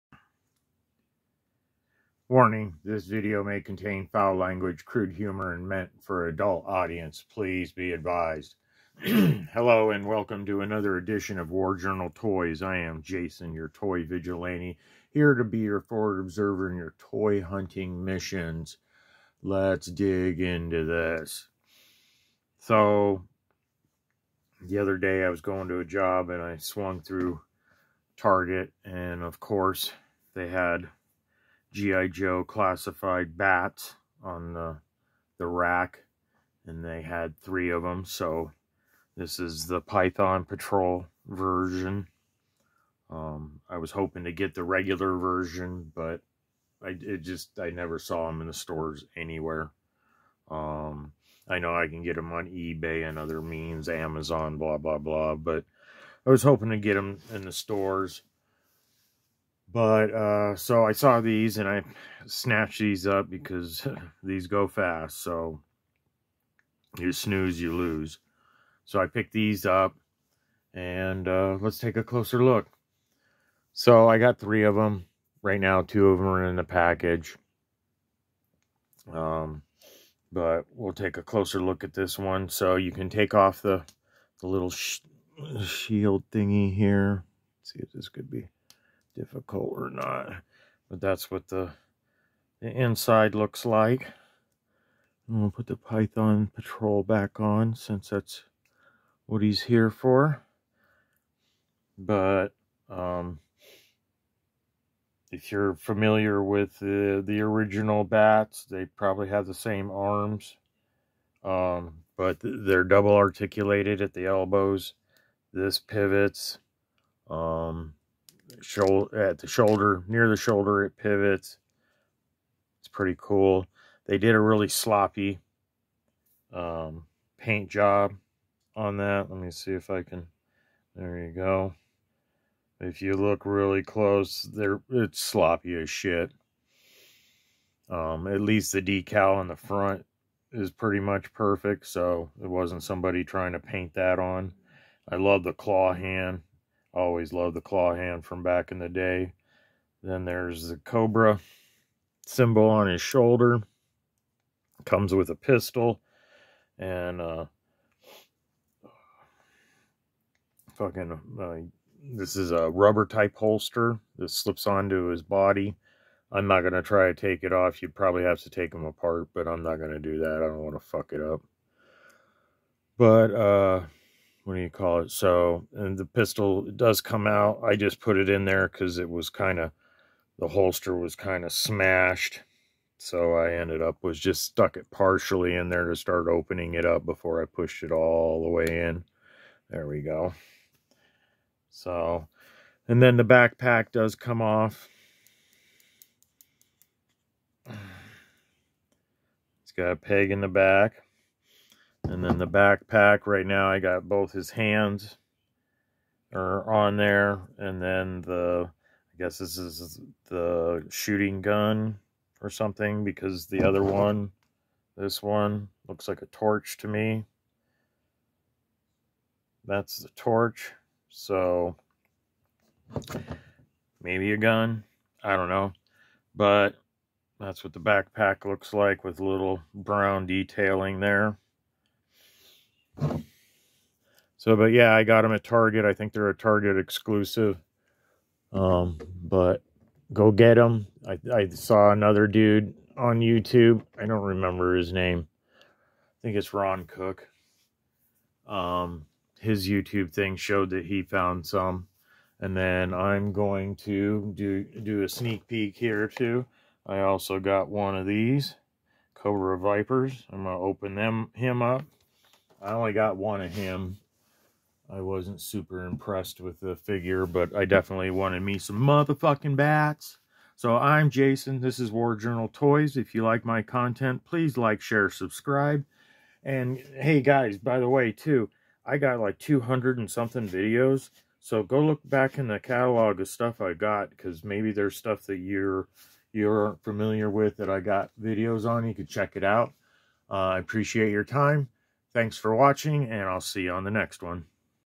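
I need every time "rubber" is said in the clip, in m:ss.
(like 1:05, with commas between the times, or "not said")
2:42.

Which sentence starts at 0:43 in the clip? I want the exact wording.
Um, I was hoping to get the regular version, but I just I never saw them in the stores anywhere.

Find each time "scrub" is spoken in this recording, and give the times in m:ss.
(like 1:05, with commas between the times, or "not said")
not said.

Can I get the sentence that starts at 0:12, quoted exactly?
I am Jason, your toy vigilante, here to be your forward observer in your toy hunting missions.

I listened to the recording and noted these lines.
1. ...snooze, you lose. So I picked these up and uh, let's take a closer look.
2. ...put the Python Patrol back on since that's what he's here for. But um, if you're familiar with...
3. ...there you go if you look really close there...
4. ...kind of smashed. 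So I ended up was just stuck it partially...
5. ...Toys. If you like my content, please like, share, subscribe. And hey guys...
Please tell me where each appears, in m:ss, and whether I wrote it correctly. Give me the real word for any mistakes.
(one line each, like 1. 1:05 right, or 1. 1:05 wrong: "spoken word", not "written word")
1. 1:07 right
2. 1:35 right
3. 2:10 right
4. 3:01 right
5. 4:32 right.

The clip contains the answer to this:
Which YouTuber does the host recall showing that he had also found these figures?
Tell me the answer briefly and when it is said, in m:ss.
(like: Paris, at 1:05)
Ron Cook, at 4:06.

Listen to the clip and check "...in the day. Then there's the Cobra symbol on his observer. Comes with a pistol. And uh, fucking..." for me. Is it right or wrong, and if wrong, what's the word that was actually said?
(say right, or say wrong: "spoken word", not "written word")
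wrong: "shoulder", not "observer".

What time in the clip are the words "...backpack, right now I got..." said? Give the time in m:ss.
3:22.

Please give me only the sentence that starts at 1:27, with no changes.
Let's see if this could be difficult or not.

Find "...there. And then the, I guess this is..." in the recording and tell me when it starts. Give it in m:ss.
3:26.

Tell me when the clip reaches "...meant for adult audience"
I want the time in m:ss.
0:05.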